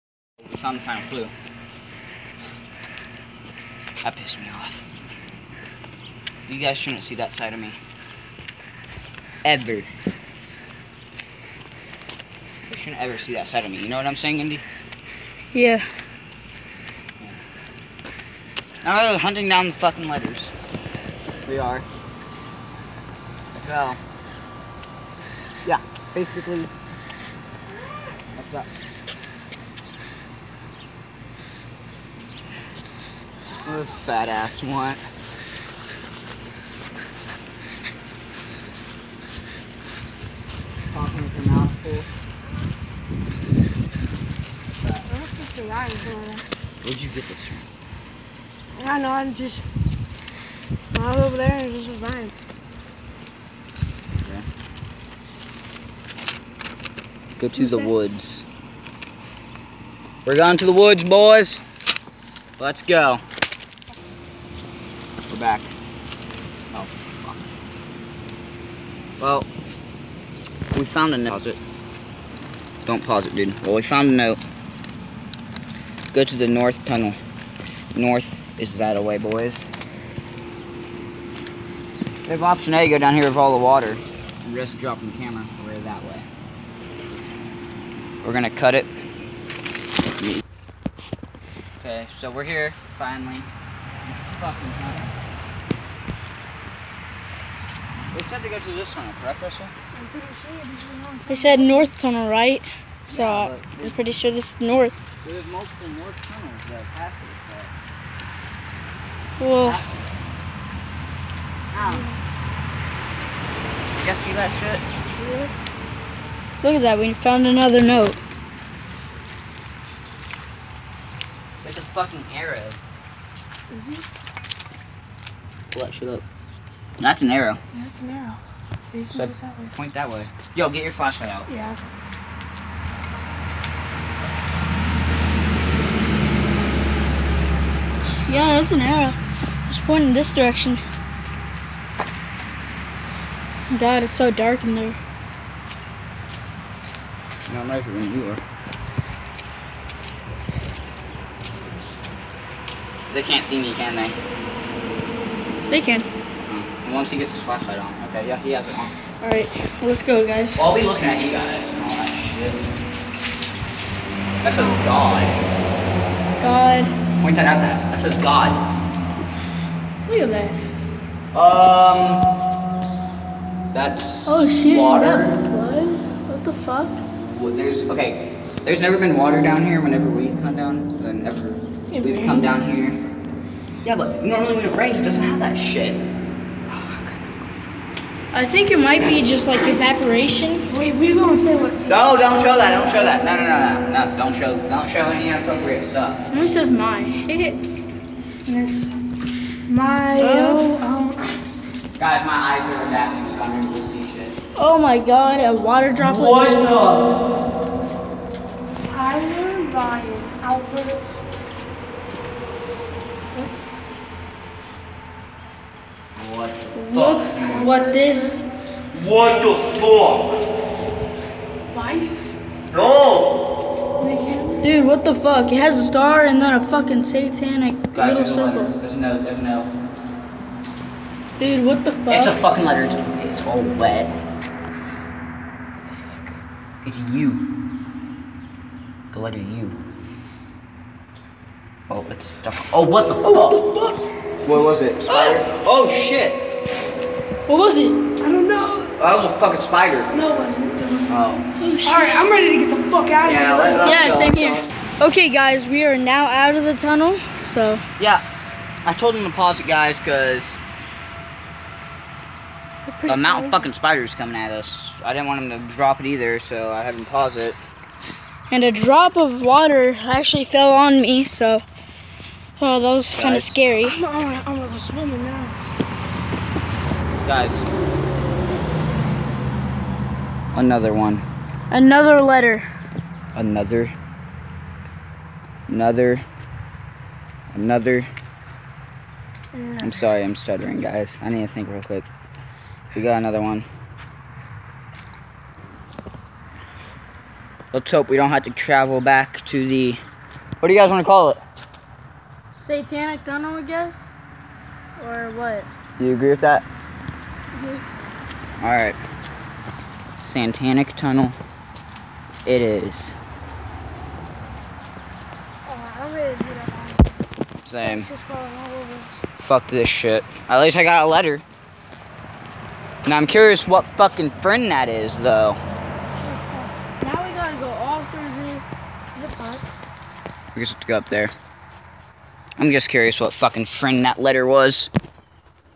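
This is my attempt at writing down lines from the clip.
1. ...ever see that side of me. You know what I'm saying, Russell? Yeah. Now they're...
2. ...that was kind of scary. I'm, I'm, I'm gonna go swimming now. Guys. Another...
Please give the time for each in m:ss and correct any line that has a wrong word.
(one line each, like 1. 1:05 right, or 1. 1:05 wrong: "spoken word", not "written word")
1. 0:13 wrong: "Indy", not "Russell"
2. 4:32 right.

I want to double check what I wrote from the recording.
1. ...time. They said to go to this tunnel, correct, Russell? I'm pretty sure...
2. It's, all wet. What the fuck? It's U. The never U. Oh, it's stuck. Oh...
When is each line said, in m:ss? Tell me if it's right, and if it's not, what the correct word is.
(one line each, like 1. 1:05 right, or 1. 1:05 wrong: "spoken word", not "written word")
1. 1:34 right
2. 3:53 wrong: "letter", not "never".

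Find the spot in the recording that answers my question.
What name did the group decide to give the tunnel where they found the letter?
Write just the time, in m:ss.
5:02.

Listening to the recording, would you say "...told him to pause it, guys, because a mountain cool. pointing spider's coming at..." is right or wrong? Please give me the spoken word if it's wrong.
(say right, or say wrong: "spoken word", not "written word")
wrong: "fucking", not "pointing".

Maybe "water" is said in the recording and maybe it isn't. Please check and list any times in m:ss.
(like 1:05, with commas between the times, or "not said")
1:23, 2:54, 2:59, 3:25, 4:29.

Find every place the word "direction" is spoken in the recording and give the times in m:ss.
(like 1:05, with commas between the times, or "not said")
2:20.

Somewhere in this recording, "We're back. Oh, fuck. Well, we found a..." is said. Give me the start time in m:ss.
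1:05.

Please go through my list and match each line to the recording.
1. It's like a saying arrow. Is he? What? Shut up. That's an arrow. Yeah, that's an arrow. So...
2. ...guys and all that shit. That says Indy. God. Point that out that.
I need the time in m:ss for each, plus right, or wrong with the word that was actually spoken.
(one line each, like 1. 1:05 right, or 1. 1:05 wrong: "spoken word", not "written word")
1. 2:01 wrong: "fucking", not "saying"
2. 2:41 wrong: "God", not "Indy".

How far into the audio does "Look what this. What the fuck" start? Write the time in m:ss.
3:36.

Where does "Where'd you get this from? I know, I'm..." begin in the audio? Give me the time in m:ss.
0:46.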